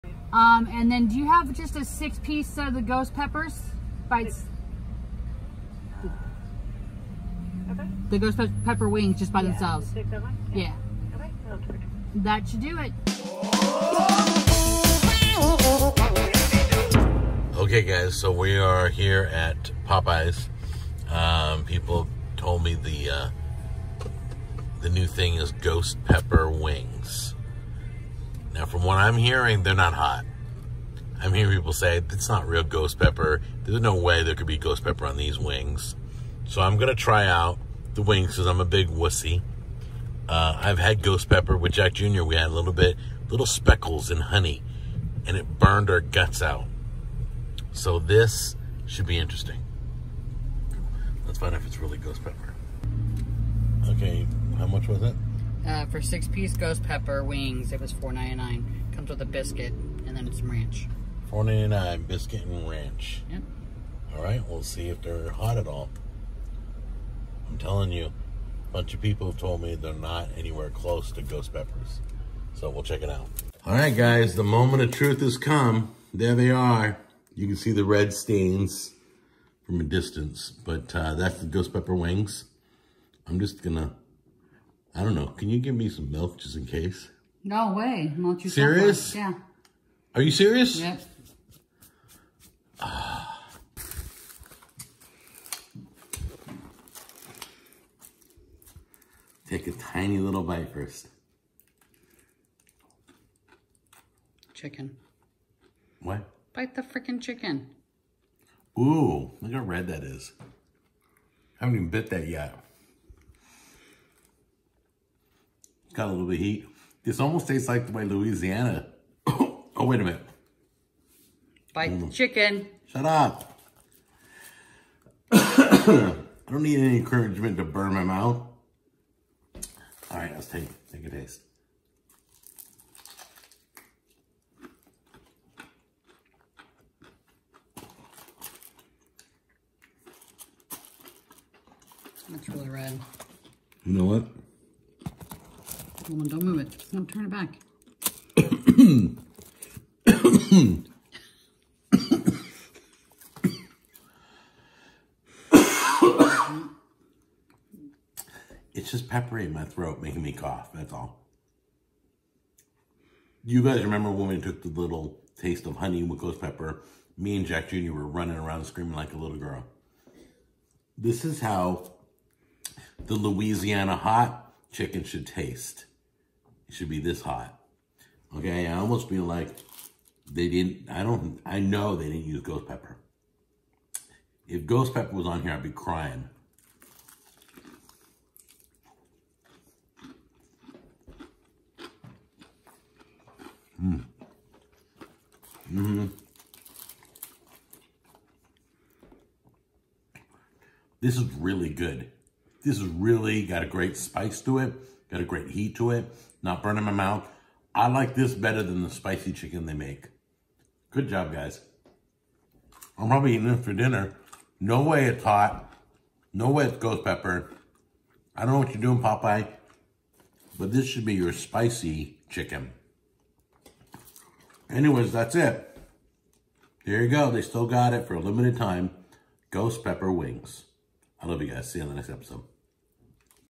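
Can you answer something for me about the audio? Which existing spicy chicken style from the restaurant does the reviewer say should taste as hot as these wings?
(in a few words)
Louisiana hot chicken.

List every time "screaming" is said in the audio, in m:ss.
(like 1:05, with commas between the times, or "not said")
2:48.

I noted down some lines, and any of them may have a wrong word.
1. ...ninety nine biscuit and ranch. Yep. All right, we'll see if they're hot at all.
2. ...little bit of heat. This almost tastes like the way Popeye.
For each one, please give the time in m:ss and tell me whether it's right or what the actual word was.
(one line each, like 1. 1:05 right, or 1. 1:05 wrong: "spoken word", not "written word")
1. 1:01 right
2. 1:56 wrong: "Louisiana", not "Popeye".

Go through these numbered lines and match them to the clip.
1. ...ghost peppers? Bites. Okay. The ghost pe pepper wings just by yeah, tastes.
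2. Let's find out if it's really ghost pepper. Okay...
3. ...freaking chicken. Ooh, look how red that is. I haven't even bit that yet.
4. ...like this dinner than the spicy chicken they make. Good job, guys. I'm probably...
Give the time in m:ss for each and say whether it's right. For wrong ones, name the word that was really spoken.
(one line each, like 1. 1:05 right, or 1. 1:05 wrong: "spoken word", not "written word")
1. 0:02 wrong: "themselves", not "tastes"
2. 0:51 right
3. 1:46 right
4. 3:27 wrong: "better", not "dinner".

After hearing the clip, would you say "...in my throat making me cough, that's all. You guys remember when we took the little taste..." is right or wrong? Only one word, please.
right.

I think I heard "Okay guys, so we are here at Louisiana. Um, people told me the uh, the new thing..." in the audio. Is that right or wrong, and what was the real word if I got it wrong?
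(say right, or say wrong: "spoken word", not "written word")
wrong: "Popeyes", not "Louisiana".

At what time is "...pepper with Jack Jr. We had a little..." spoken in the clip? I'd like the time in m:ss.
0:41.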